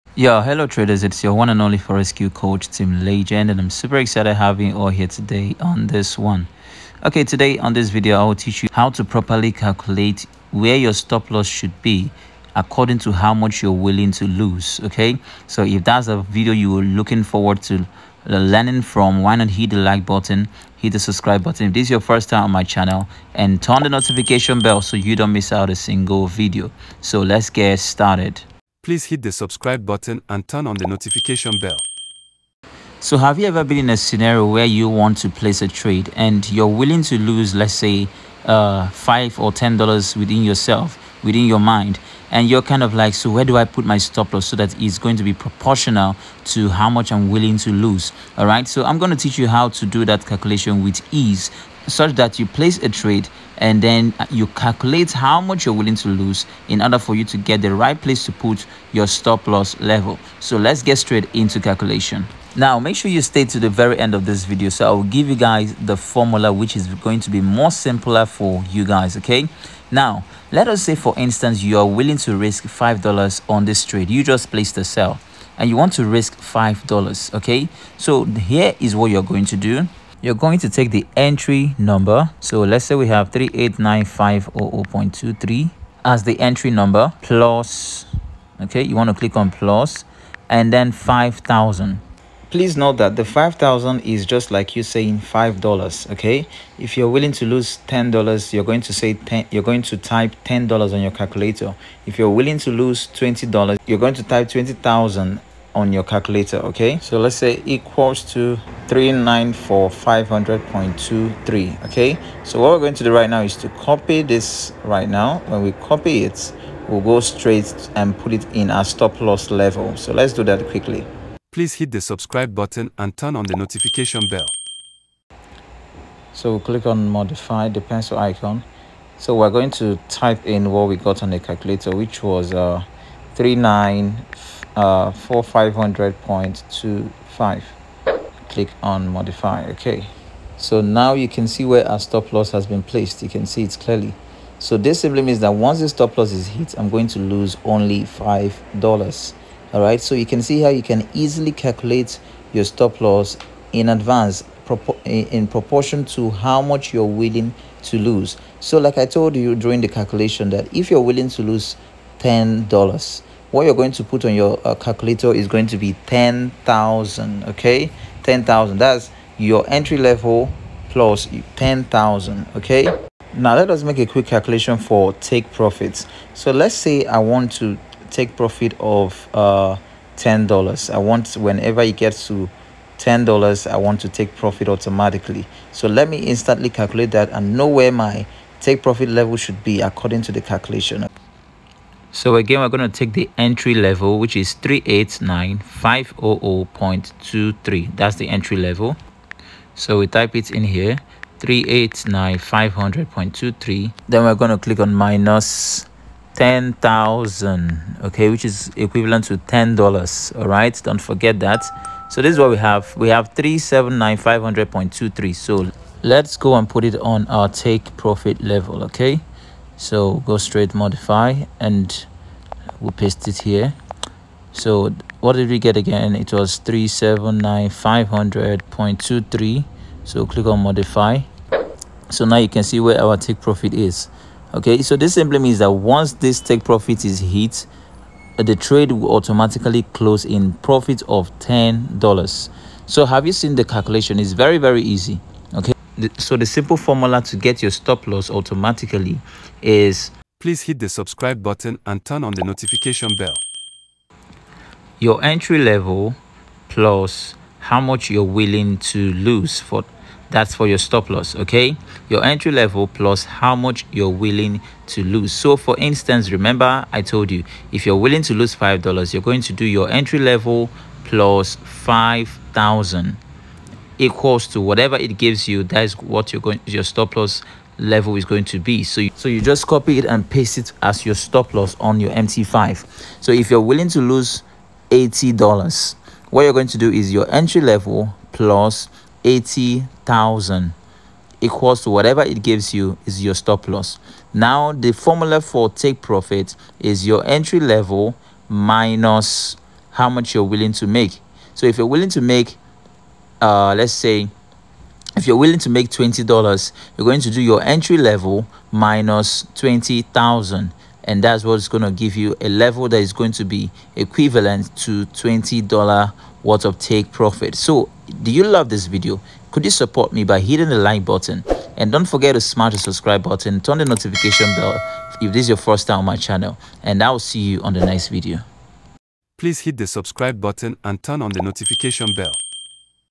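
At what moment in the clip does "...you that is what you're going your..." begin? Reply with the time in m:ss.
4:35.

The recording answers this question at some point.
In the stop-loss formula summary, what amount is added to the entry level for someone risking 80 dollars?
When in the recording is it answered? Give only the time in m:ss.
4:49.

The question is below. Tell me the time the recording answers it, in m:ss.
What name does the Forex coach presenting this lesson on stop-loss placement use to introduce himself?
0:02.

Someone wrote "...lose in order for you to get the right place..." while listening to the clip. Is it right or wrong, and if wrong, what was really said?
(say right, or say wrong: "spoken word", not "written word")
right.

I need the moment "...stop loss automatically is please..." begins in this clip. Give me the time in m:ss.
4:07.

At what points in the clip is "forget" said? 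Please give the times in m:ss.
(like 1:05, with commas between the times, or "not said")
3:31, 5:22.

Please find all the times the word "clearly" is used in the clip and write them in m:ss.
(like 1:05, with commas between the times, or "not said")
2:23.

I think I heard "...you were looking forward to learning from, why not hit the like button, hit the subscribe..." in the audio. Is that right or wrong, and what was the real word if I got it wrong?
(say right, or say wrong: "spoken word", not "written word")
right.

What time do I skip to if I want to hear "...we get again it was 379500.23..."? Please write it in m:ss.
3:45.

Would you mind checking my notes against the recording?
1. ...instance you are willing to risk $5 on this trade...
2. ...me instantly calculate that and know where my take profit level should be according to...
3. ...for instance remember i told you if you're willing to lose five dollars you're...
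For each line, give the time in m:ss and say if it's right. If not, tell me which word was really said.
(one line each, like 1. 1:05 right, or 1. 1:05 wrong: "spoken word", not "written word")
1. 1:11 right
2. 3:06 right
3. 4:25 right.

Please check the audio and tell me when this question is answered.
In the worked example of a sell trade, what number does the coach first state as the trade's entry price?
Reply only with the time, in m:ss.
1:23.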